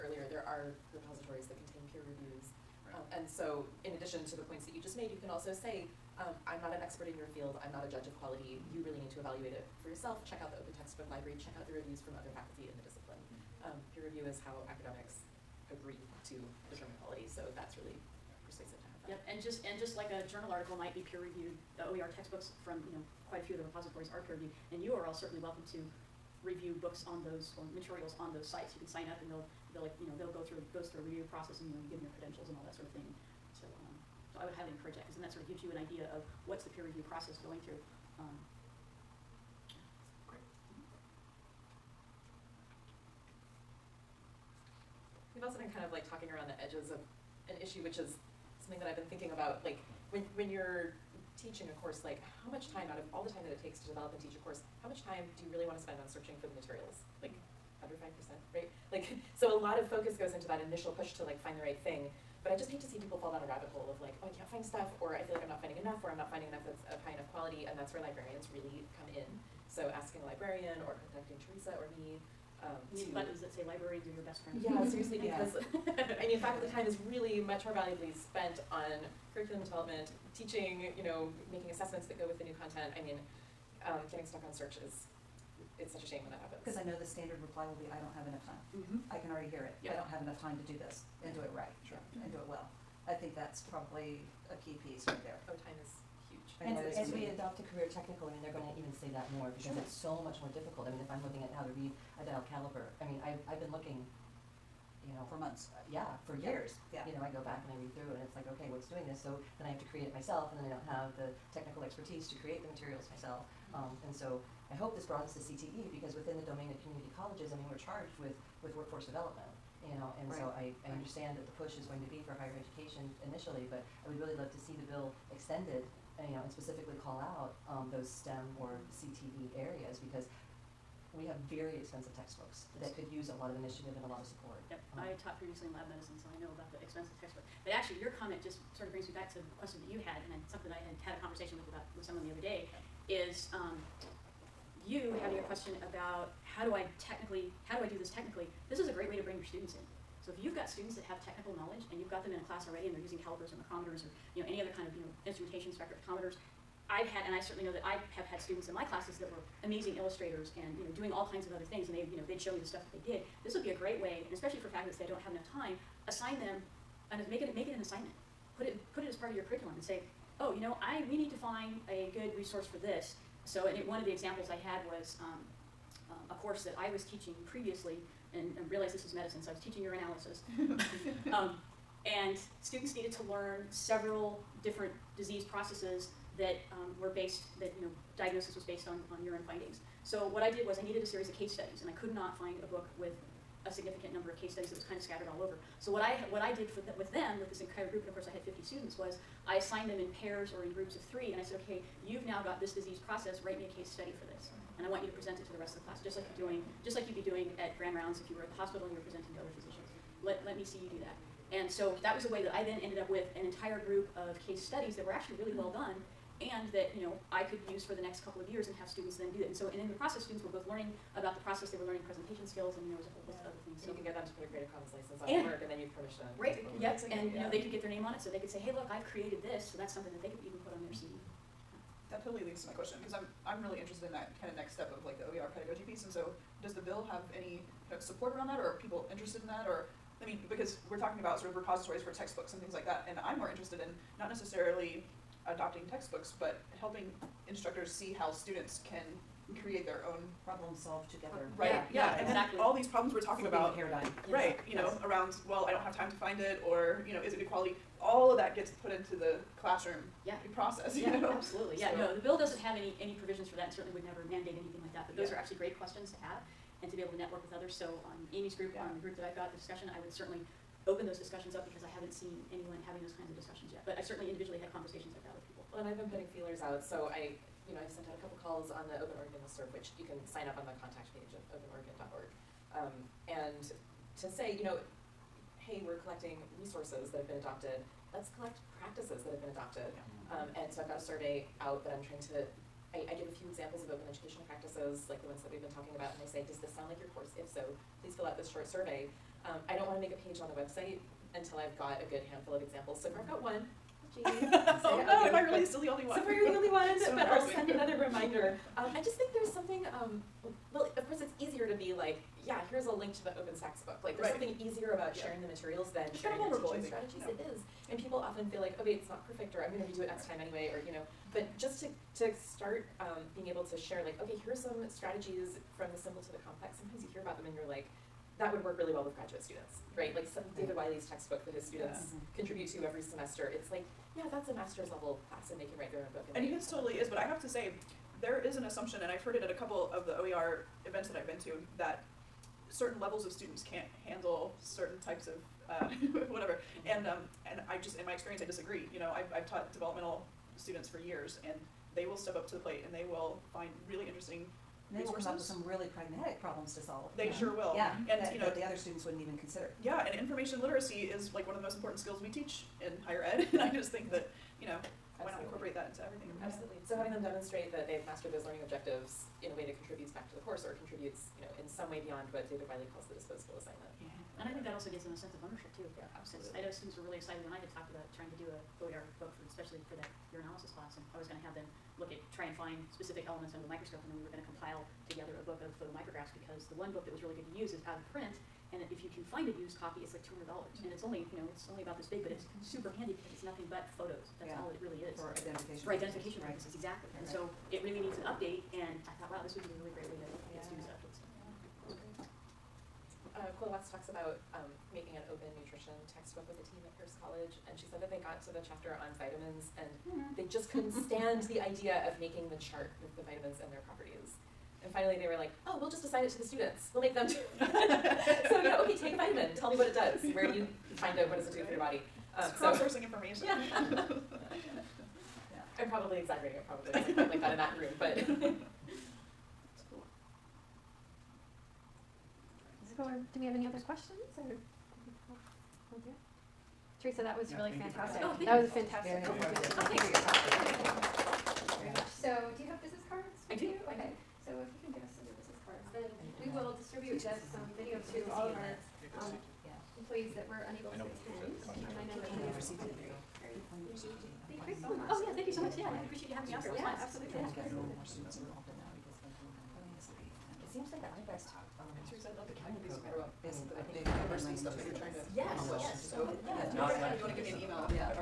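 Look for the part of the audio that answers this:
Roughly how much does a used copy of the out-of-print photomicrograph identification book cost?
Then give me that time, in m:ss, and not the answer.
6:30.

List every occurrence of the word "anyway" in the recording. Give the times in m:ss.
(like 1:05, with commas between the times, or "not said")
5:20.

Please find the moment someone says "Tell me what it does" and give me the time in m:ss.
6:59.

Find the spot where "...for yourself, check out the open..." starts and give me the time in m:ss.
0:09.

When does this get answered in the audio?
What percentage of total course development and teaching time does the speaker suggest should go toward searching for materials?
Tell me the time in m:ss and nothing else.
0:57.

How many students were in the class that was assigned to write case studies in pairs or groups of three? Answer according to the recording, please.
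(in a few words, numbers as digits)
50.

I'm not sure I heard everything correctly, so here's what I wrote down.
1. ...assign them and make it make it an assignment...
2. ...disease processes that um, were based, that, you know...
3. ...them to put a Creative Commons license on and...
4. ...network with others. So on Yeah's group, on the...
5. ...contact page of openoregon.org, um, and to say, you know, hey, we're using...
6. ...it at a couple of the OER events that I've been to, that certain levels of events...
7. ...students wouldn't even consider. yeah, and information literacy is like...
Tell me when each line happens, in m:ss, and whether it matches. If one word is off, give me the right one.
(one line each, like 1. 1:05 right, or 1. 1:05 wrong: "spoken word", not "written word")
1. 2:46 right
2. 3:05 right
3. 3:44 right
4. 4:27 wrong: "Amy", not "Yeah"
5. 4:40 wrong: "collecting", not "using"
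6. 5:39 wrong: "students", not "events"
7. 5:58 right.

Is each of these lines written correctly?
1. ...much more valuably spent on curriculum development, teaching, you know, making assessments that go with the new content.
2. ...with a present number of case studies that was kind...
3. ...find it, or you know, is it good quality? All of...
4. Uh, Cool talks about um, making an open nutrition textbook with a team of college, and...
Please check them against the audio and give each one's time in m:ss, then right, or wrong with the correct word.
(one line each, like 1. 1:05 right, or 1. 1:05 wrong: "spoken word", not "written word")
1. 1:17 right
2. 3:12 wrong: "significant", not "present"
3. 4:16 right
4. 6:43 right.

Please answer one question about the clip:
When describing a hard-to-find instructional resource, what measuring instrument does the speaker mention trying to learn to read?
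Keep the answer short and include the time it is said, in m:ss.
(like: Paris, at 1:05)
dial caliper, at 1:42.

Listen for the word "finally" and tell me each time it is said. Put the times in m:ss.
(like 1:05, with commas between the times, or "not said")
6:54.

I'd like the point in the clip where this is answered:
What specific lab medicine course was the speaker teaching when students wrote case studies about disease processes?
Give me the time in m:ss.
2:59.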